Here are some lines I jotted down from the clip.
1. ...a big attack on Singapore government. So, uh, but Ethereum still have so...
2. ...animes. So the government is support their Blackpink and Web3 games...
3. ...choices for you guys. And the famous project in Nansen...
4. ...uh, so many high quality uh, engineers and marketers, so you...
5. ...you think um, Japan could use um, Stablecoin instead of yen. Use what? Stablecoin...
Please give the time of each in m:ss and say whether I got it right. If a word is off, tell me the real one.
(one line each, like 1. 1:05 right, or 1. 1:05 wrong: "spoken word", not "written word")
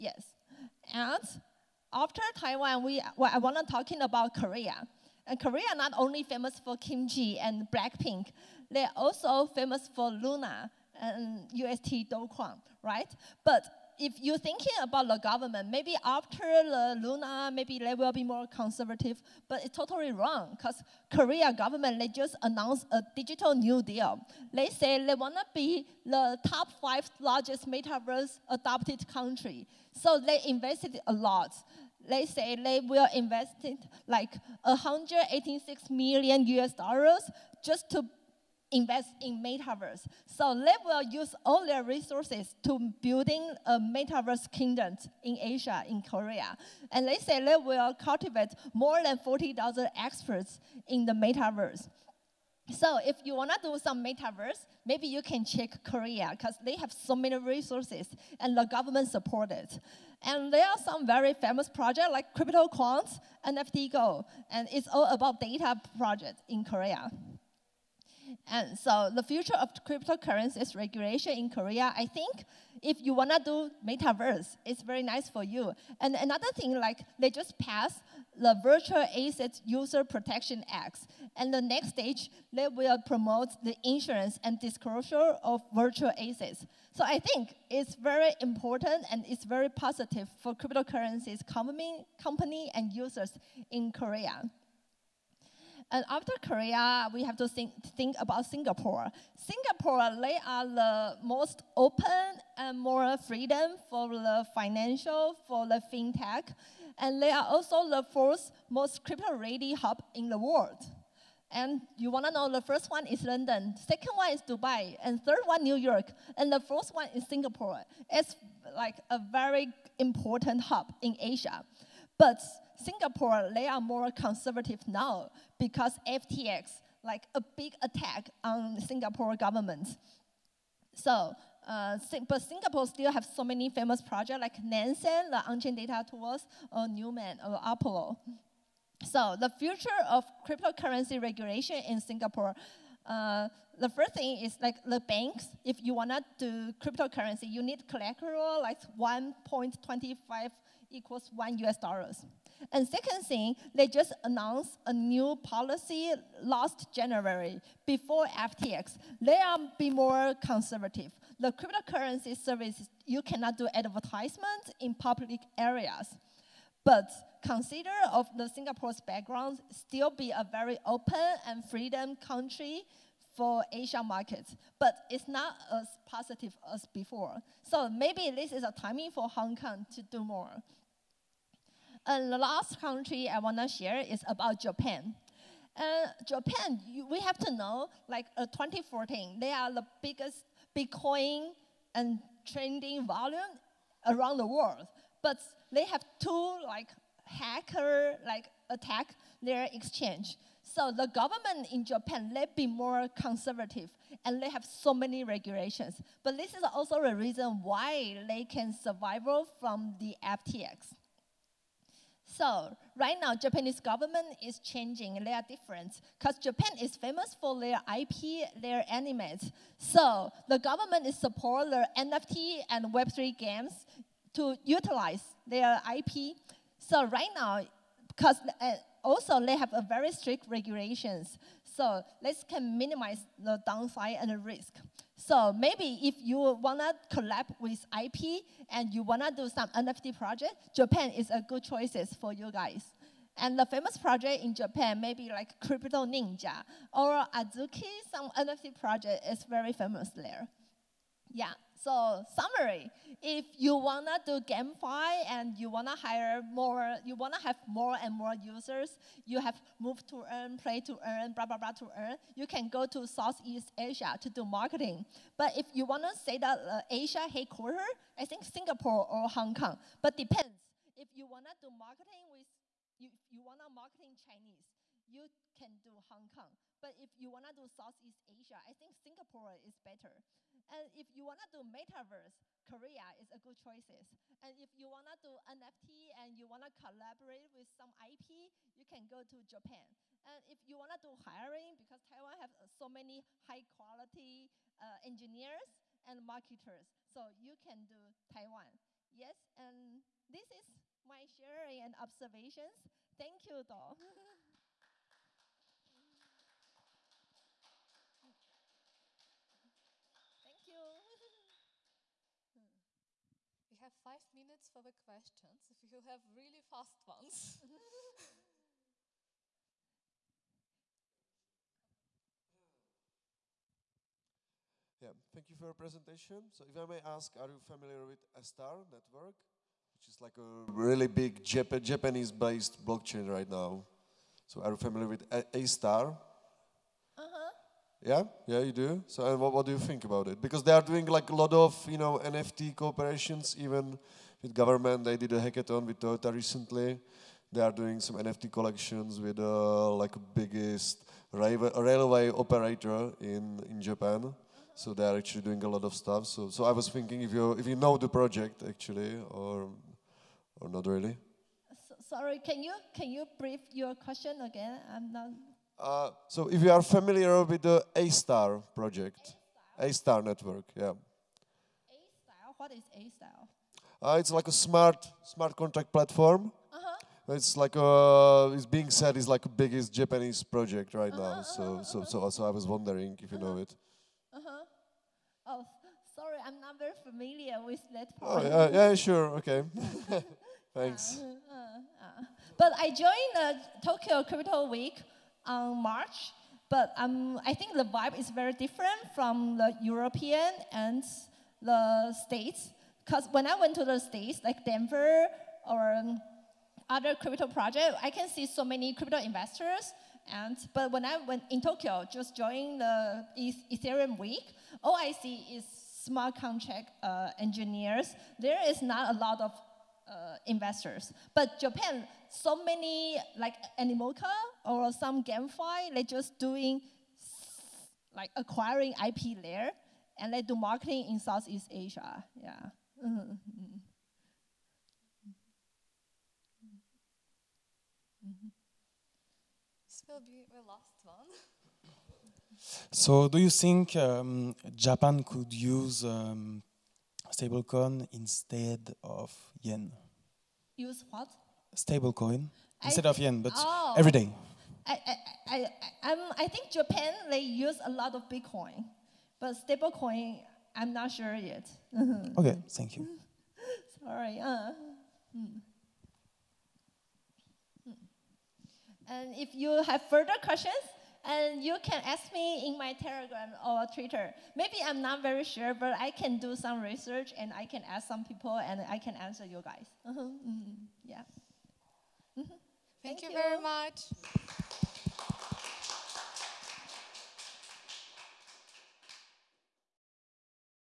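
1. 2:07 wrong: "Singapore", not "Ethereum"
2. 3:38 wrong: "NFT", not "Blackpink"
3. 4:01 wrong: "Japan", not "Nansen"
4. 4:52 right
5. 7:23 right.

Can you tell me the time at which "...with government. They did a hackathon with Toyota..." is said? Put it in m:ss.
5:44.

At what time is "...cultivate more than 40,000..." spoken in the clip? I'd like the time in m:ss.
0:47.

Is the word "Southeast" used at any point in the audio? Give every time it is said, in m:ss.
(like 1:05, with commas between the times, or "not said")
4:23, 4:37, 7:11.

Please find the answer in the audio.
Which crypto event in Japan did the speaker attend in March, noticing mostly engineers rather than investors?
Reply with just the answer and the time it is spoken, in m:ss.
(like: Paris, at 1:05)
Tokyo Crypto Week, at 6:33.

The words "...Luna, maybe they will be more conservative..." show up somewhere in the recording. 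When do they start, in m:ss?
0:17.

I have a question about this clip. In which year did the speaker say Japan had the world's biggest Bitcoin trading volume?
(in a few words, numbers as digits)
2014.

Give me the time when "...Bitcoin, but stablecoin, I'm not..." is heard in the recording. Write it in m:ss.
7:38.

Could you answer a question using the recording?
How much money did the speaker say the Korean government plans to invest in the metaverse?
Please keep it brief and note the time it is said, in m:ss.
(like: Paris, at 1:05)
186 million US dollars, at 0:34.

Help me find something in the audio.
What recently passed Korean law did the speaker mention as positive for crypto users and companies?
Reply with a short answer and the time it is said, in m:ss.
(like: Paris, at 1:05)
Virtual Assets User Protection Act, at 1:18.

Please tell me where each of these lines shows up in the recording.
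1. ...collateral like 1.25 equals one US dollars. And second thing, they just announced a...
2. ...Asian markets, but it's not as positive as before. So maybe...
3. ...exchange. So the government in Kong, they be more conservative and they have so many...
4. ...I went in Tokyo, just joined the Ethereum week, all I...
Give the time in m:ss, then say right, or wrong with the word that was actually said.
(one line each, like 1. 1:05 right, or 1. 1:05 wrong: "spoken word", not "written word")
1. 2:27 right
2. 2:53 right
3. 3:19 wrong: "Japan", not "Kong"
4. 6:51 right.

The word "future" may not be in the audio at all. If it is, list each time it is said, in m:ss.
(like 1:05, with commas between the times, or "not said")
1:09, 2:19.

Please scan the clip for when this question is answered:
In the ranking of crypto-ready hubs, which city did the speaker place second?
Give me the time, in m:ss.
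1:54.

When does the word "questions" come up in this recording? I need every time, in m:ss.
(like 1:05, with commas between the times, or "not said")
5:14, 6:03, 7:50.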